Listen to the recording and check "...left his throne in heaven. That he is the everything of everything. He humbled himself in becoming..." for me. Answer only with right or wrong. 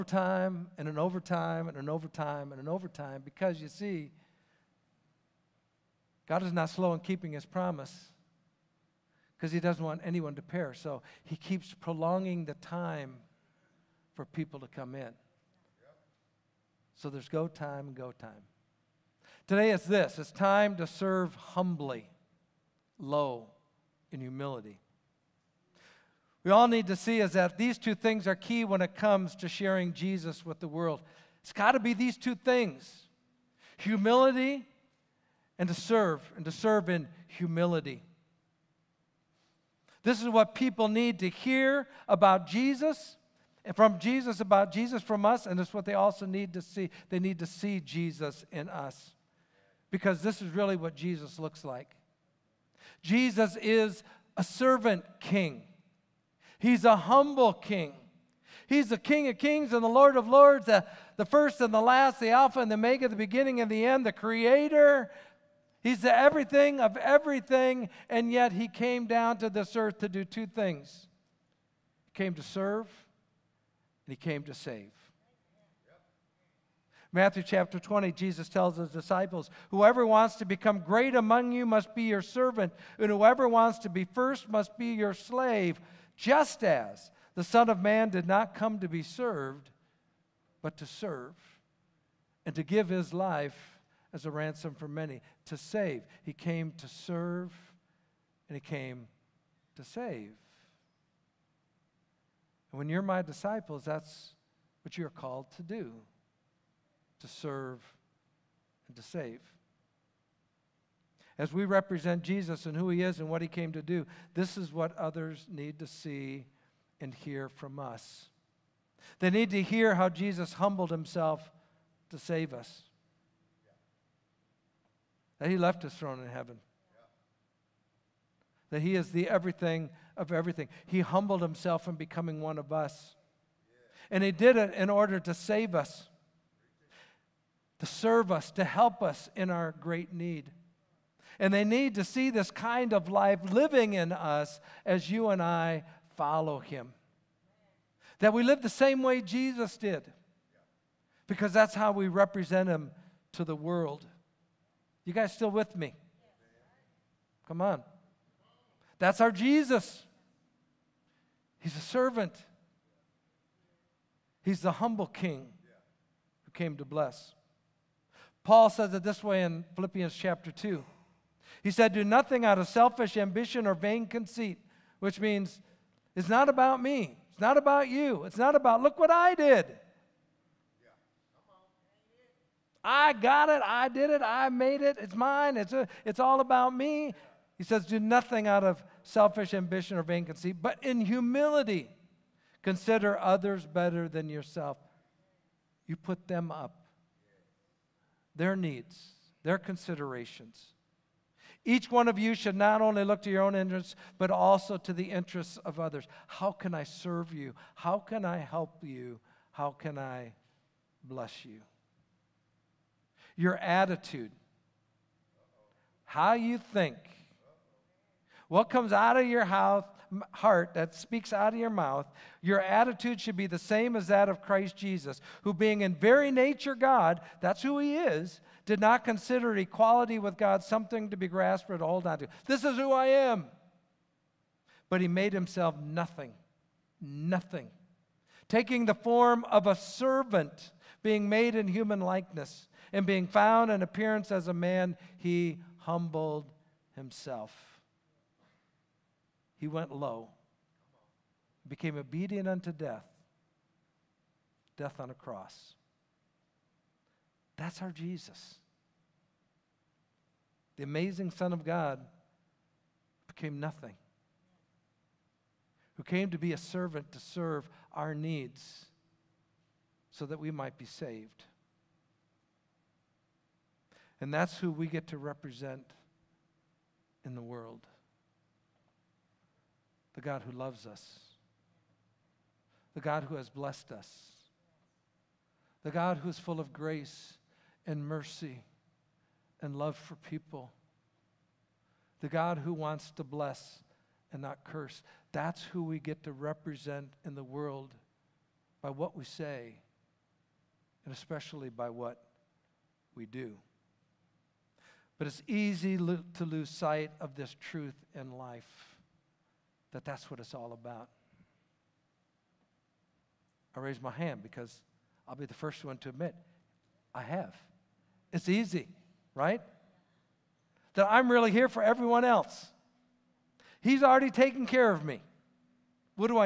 right.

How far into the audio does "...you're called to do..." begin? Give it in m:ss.
1:44.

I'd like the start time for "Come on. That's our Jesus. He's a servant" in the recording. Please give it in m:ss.
2:37.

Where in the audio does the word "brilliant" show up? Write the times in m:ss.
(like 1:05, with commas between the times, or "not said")
not said.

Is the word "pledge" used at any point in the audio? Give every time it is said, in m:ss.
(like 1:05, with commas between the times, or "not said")
not said.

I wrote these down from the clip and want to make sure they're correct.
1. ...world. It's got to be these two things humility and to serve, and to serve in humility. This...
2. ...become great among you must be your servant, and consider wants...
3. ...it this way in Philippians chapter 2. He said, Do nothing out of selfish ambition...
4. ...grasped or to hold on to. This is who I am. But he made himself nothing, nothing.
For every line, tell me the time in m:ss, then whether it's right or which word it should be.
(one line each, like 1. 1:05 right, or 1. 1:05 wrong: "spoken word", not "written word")
1. 0:30 right
2. 1:20 wrong: "whoever", not "consider"
3. 2:48 right
4. 3:51 right.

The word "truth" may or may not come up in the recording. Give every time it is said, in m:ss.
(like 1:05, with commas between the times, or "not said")
5:07.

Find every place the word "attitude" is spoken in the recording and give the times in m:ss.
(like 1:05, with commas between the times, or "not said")
3:33, 3:42.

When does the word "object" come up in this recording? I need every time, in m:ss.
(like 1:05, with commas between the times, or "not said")
not said.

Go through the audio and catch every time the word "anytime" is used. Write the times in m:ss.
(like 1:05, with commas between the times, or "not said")
not said.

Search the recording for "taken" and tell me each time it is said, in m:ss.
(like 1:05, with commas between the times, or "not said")
5:24.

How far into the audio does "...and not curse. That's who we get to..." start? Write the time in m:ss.
4:54.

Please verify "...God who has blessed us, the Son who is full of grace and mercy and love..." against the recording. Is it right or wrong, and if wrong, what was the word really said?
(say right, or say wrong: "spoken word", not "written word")
wrong: "God", not "Son".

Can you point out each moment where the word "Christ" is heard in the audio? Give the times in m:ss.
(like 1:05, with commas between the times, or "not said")
3:44.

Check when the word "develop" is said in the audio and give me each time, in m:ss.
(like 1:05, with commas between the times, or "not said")
not said.